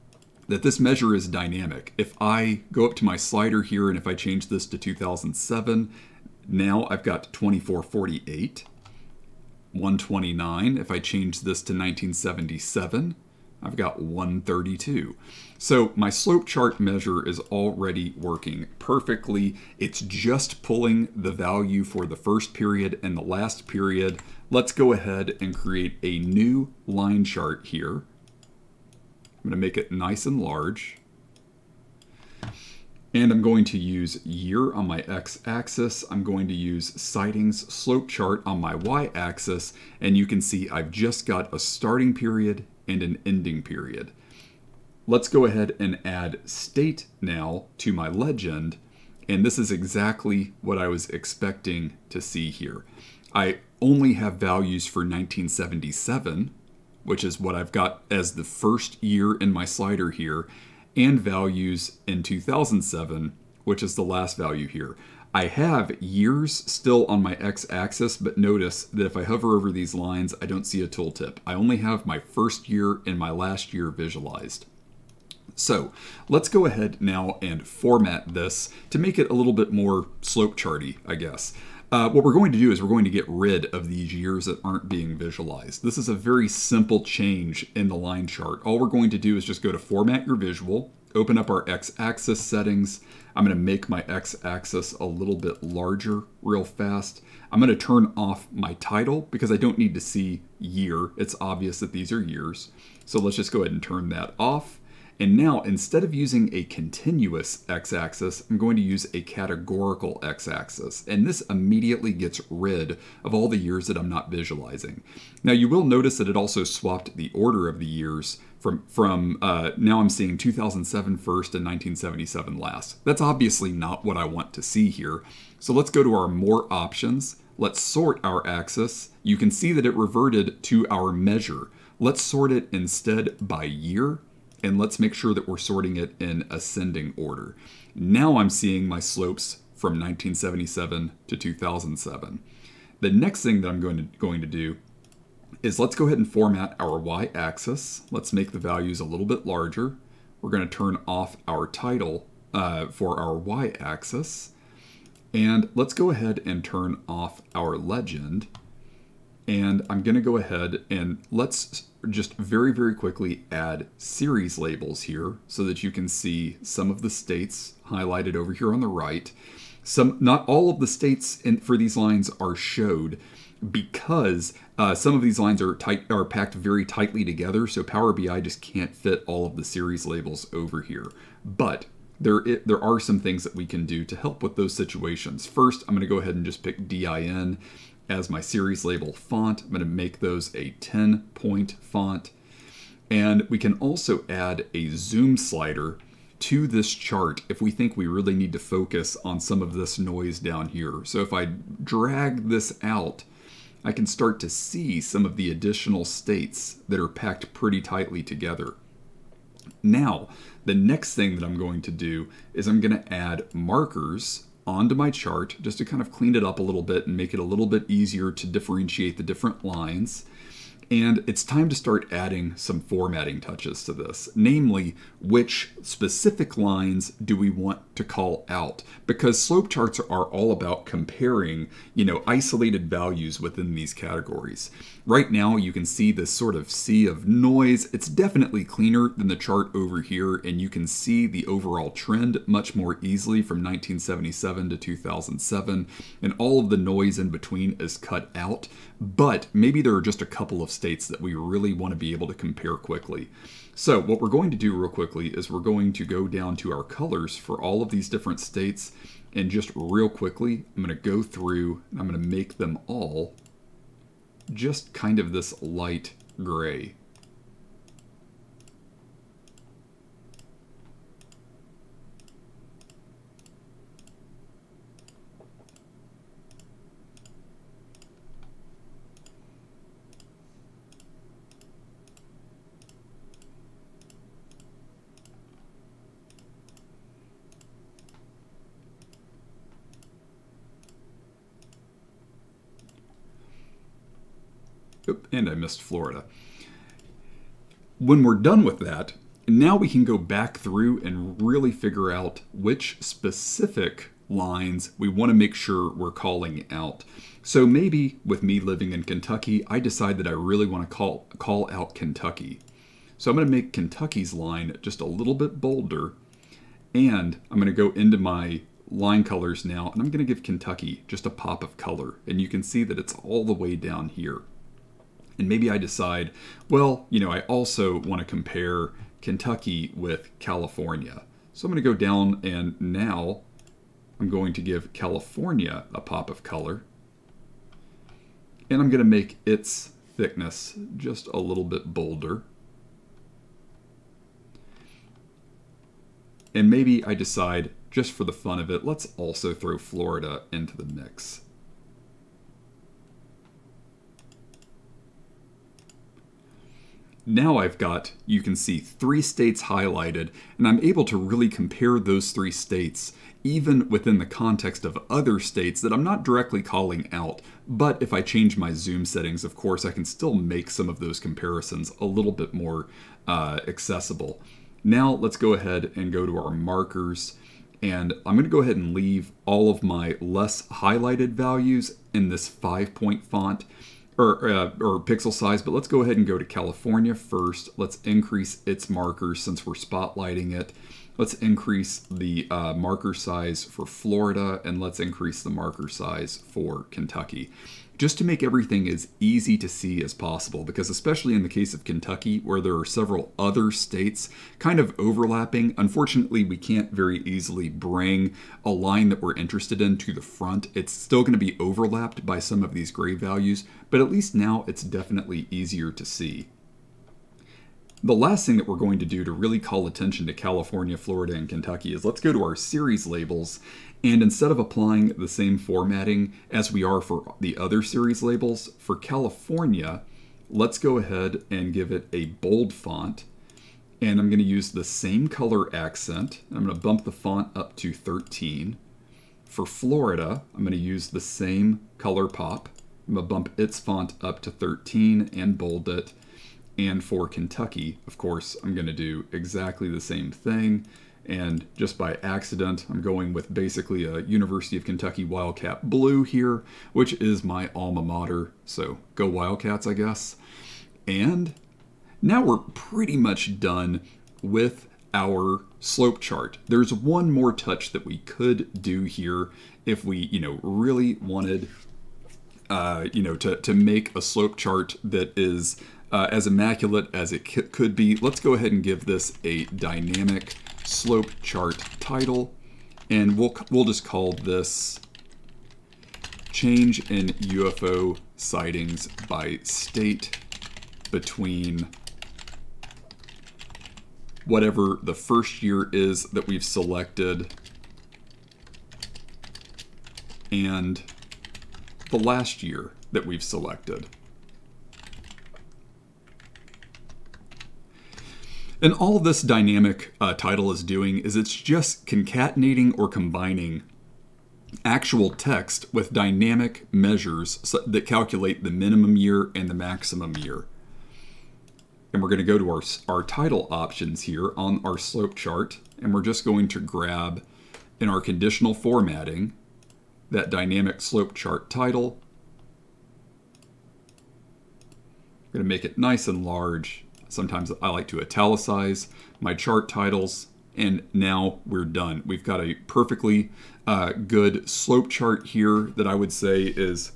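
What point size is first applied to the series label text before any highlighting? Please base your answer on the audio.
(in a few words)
10.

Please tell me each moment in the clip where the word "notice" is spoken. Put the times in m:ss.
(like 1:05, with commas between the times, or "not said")
1:08, 1:55.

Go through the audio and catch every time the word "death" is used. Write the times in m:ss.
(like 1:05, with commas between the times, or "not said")
not said.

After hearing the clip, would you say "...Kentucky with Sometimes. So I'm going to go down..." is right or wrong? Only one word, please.
wrong.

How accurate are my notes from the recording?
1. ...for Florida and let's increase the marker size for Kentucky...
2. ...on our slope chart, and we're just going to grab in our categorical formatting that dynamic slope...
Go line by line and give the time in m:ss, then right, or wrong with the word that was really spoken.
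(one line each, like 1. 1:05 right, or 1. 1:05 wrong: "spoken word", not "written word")
1. 6:33 right
2. 8:44 wrong: "conditional", not "categorical".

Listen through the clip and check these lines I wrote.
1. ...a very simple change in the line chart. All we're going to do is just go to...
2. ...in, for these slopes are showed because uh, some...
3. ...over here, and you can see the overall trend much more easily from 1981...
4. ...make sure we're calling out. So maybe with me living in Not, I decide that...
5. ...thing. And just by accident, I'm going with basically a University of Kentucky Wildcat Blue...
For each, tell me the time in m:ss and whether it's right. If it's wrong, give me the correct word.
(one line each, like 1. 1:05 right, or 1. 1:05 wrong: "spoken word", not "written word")
1. 1:26 right
2. 2:51 wrong: "lines", not "slopes"
3. 3:59 wrong: "1977", not "1981"
4. 5:05 wrong: "Kentucky", not "Not"
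5. 7:30 right.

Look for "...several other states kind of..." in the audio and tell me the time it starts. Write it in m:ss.
6:42.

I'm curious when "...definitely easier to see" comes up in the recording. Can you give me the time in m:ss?
6:54.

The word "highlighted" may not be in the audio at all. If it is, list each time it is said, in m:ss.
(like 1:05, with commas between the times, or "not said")
2:47, 5:59, 6:20.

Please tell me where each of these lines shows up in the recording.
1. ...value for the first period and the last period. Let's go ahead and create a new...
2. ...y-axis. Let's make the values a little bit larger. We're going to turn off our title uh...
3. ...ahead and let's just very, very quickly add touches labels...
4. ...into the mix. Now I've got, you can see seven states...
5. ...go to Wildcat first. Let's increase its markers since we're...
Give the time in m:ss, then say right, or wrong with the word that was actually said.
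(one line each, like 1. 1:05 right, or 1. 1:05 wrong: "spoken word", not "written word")
1. 0:21 right
2. 2:26 right
3. 2:40 wrong: "series", not "touches"
4. 5:50 wrong: "three", not "seven"
5. 6:26 wrong: "California", not "Wildcat".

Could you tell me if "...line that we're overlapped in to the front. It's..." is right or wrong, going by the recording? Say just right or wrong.
wrong.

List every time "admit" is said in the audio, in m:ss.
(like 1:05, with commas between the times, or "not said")
not said.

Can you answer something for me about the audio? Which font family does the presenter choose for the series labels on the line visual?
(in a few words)
DIN.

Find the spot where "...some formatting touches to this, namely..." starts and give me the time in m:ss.
3:42.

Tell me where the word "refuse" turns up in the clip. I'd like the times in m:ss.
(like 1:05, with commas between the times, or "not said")
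not said.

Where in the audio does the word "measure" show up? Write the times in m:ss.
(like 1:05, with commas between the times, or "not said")
0:00, 0:16, 2:11, 8:36.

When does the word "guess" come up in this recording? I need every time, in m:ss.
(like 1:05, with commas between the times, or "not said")
1:21, 7:39.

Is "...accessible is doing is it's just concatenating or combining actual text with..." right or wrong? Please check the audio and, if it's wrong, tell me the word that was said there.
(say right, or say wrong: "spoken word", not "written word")
wrong: "title", not "accessible".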